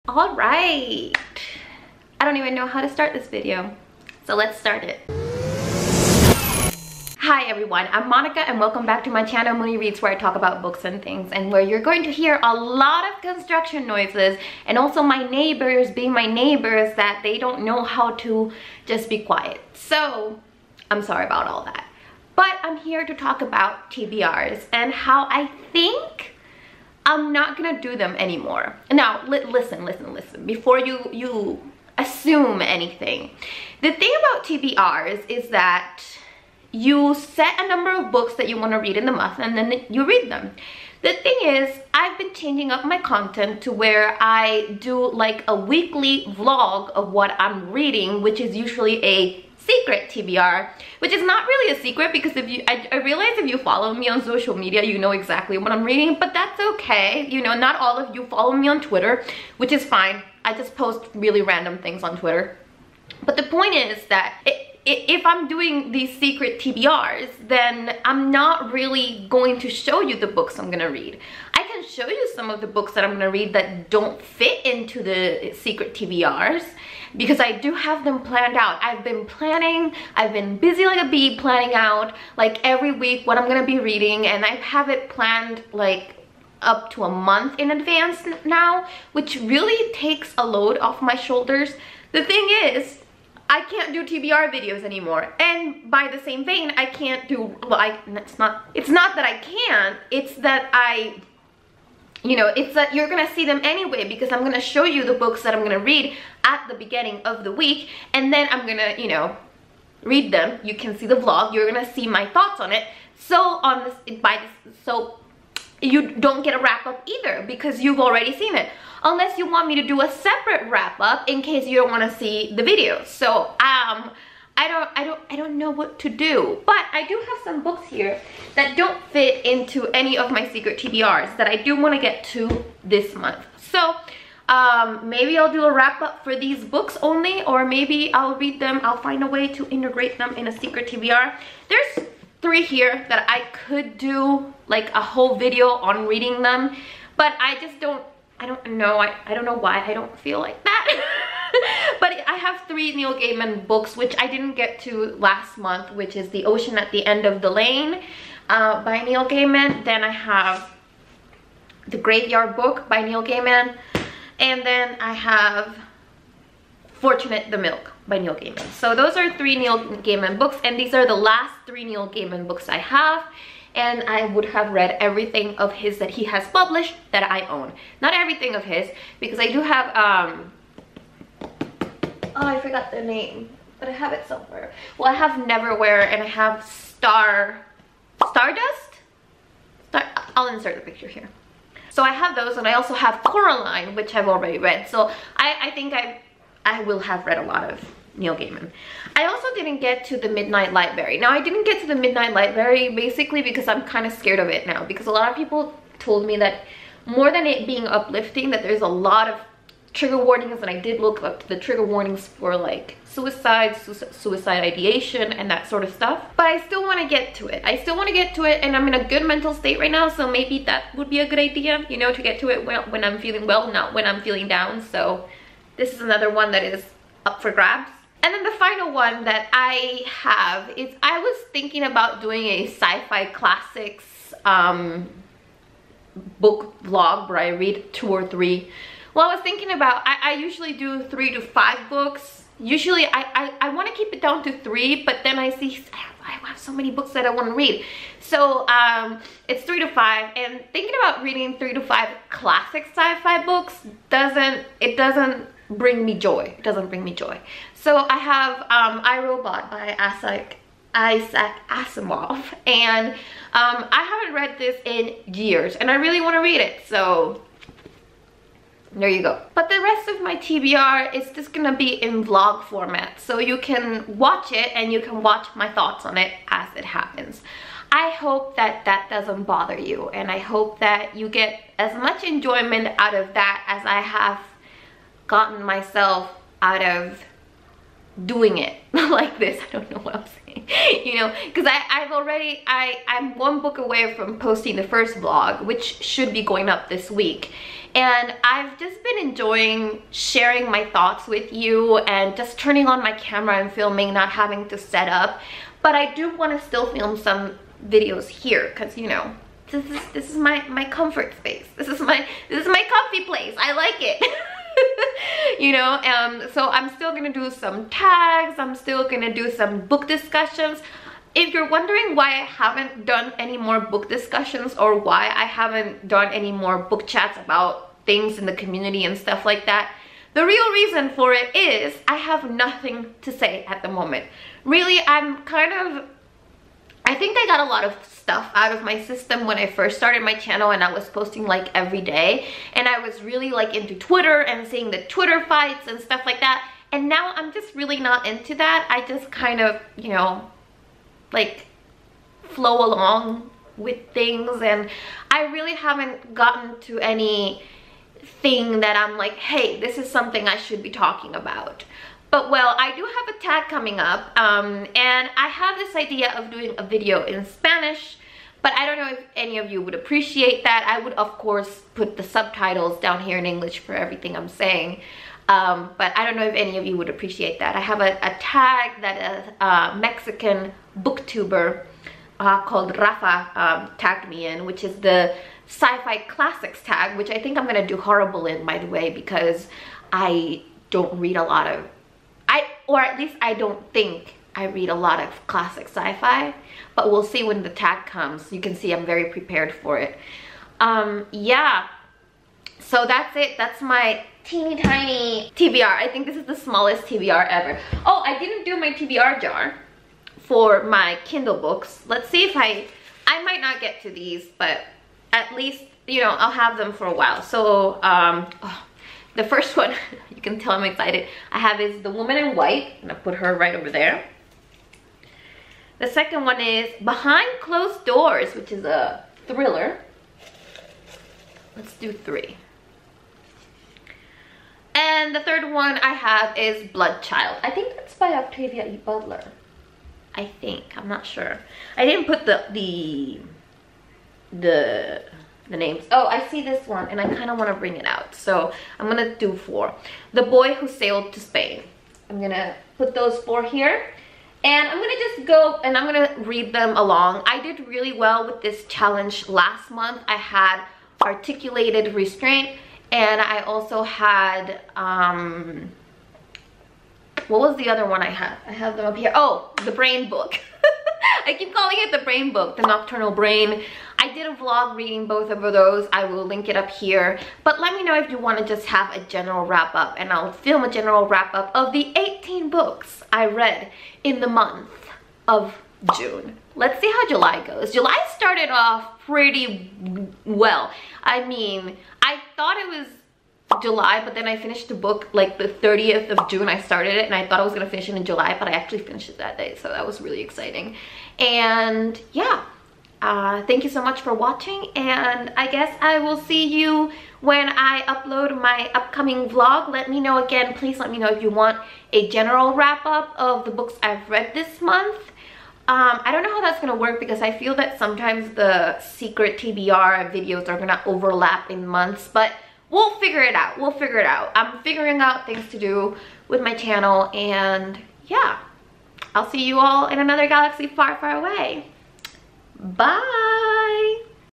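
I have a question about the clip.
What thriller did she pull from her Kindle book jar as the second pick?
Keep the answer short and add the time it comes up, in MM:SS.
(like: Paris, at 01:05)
Behind Closed Doors, at 07:07.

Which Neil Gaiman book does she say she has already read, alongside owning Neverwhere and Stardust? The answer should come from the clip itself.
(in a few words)
Coraline.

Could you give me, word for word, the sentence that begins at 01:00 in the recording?
I just post really random things on Twitter.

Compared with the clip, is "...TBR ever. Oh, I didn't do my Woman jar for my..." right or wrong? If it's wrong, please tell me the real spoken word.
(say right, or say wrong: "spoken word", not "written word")
wrong: "TBR", not "Woman".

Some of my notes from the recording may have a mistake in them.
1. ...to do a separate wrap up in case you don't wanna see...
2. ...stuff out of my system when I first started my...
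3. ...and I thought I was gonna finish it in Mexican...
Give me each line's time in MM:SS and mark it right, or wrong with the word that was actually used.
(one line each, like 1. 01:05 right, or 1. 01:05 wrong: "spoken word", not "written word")
1. 01:59 right
2. 05:38 right
3. 08:17 wrong: "July", not "Mexican".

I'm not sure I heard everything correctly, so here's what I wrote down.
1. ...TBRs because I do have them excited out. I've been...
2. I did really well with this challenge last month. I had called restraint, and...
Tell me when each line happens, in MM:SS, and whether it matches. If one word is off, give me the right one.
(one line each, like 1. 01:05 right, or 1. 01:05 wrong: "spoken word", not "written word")
1. 01:15 wrong: "planned", not "excited"
2. 07:37 wrong: "articulated", not "called".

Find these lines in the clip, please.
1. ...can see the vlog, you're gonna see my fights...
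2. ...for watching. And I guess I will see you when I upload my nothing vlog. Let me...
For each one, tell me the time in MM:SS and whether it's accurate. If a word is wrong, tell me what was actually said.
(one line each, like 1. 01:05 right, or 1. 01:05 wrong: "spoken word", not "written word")
1. 01:50 wrong: "thoughts", not "fights"
2. 08:24 wrong: "upcoming", not "nothing".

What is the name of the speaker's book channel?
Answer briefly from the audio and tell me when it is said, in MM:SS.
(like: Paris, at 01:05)
Mooni Reads, at 00:09.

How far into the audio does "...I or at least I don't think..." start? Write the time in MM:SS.
06:32.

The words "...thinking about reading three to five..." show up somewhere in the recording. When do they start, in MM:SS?
04:10.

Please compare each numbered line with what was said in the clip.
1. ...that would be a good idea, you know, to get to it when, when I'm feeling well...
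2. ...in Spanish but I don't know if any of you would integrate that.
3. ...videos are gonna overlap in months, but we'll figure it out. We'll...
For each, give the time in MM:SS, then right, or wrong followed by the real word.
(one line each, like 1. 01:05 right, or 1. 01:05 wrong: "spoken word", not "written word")
1. 03:40 right
2. 06:07 wrong: "appreciate", not "integrate"
3. 08:40 right.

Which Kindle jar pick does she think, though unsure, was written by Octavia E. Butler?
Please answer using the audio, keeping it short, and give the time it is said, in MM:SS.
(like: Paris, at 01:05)
Bloodchild, at 07:16.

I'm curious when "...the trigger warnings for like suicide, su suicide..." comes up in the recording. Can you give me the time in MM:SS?
03:31.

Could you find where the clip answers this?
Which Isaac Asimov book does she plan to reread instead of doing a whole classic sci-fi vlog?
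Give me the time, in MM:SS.
04:19.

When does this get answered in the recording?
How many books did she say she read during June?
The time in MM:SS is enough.
08:02.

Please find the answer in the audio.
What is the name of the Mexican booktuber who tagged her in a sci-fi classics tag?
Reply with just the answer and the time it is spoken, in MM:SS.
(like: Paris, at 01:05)
Rafa, at 06:22.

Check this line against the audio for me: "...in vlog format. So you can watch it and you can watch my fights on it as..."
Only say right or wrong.
wrong.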